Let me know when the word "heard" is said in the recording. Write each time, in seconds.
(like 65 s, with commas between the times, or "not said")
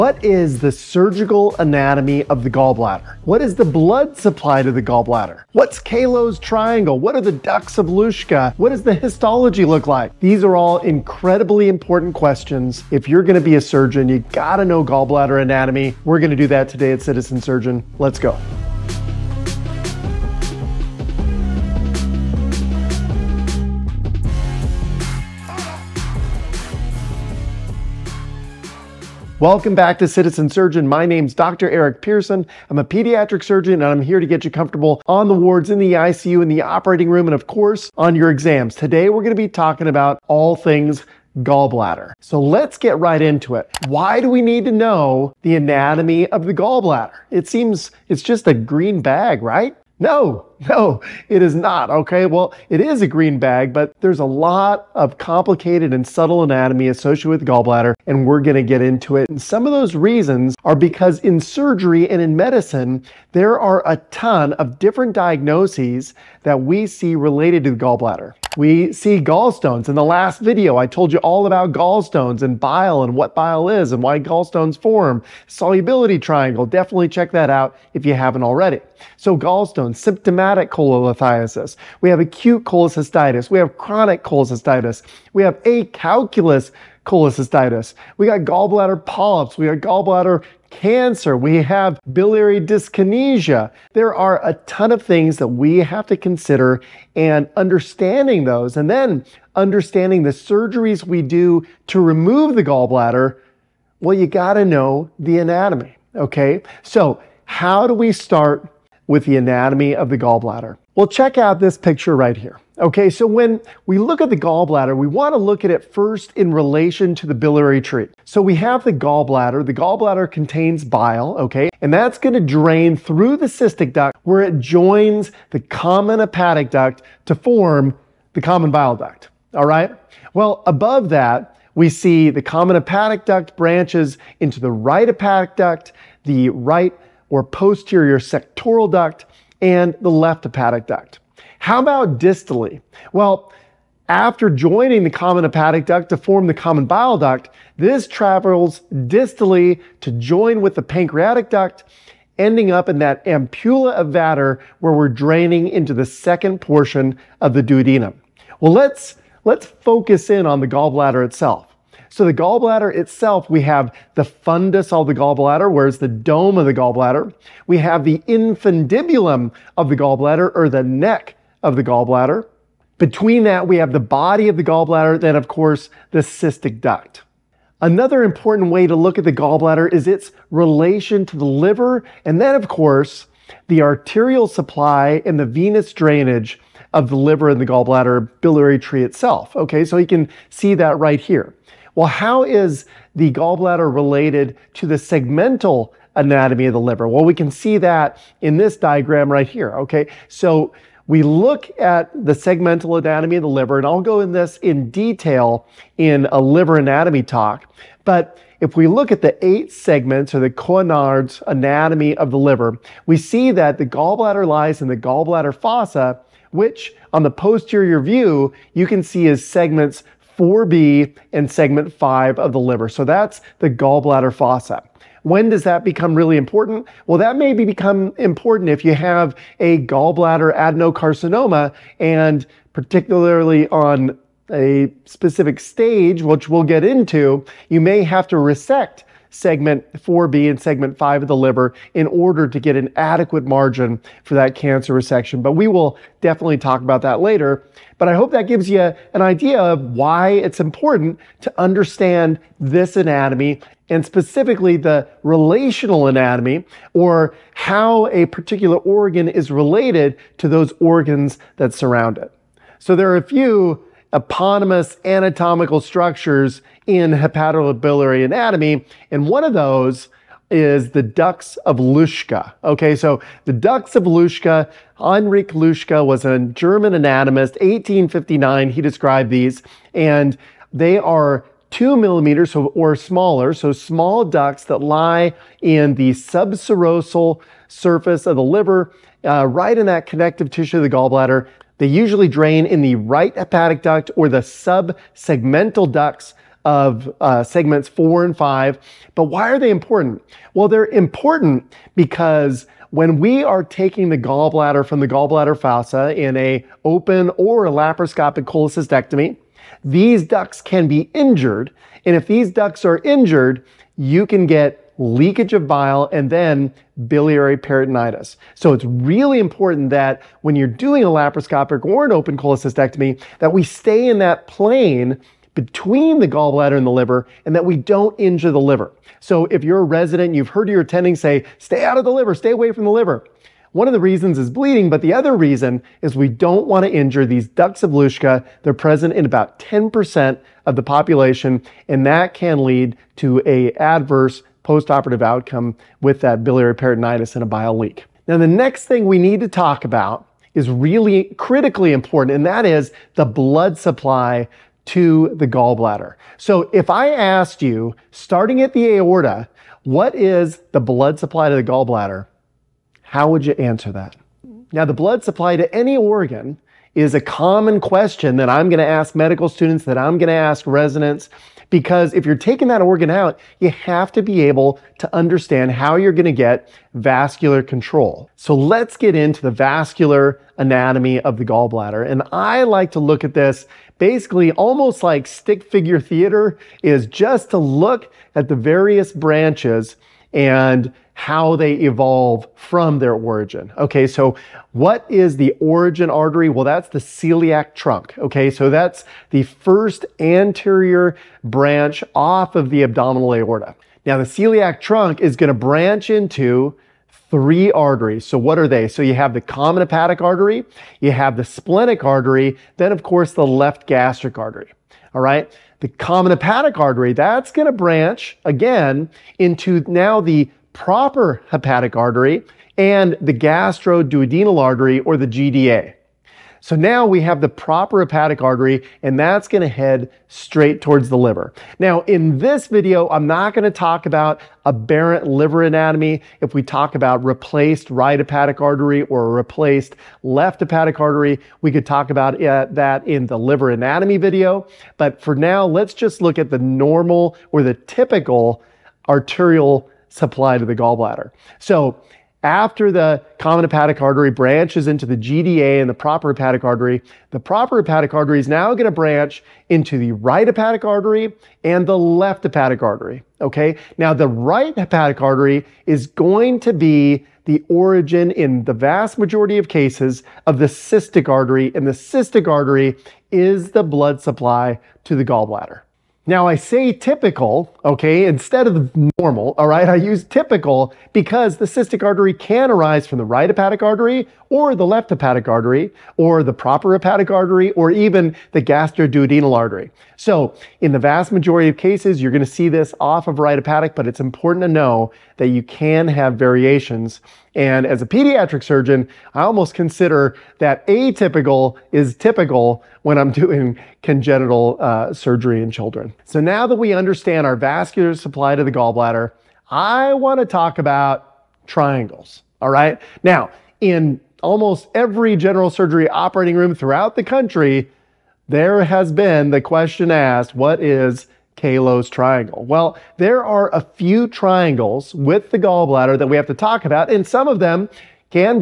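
330 s.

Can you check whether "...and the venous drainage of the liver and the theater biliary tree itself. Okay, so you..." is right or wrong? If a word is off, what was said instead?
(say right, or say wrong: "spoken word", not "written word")
wrong: "gallbladder", not "theater".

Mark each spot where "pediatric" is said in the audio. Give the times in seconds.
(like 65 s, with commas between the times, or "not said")
32 s, 498 s.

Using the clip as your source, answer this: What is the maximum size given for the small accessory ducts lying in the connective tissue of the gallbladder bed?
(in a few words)
2 millimeters.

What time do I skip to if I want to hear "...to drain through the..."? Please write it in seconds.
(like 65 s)
122 s.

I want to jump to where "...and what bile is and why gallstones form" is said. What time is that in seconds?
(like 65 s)
73 s.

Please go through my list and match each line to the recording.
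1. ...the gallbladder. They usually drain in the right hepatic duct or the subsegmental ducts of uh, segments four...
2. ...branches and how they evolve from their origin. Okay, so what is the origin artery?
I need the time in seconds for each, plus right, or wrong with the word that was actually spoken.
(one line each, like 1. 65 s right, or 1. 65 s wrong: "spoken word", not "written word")
1. 290 s right
2. 389 s right.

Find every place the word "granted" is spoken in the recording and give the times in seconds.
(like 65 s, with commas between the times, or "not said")
not said.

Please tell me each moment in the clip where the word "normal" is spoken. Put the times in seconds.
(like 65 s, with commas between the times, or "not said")
446 s, 479 s.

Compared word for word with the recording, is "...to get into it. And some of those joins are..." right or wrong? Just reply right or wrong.
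wrong.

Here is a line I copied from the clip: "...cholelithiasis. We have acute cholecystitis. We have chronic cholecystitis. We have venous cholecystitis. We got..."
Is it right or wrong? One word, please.
wrong.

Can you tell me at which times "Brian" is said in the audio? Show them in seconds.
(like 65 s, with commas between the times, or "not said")
not said.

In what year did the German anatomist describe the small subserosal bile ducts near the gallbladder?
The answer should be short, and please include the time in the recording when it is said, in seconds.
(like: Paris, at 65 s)
1859, at 277 s.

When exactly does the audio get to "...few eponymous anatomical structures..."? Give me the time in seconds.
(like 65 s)
263 s.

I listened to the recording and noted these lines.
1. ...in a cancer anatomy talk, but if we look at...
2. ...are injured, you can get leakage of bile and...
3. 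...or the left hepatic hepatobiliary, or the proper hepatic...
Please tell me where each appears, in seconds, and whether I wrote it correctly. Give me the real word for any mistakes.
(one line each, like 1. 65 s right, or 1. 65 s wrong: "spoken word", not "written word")
1. 205 s wrong: "liver", not "cancer"
2. 312 s right
3. 484 s wrong: "artery", not "hepatobiliary".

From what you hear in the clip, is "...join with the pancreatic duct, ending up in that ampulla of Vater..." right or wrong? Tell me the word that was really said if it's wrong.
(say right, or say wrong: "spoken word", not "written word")
right.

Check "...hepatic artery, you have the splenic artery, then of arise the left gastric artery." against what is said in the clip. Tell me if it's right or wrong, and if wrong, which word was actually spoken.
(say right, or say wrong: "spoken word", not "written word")
wrong: "course", not "arise".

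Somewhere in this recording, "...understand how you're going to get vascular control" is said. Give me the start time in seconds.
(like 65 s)
375 s.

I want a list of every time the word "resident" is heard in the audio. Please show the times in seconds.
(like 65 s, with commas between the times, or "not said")
329 s, 370 s.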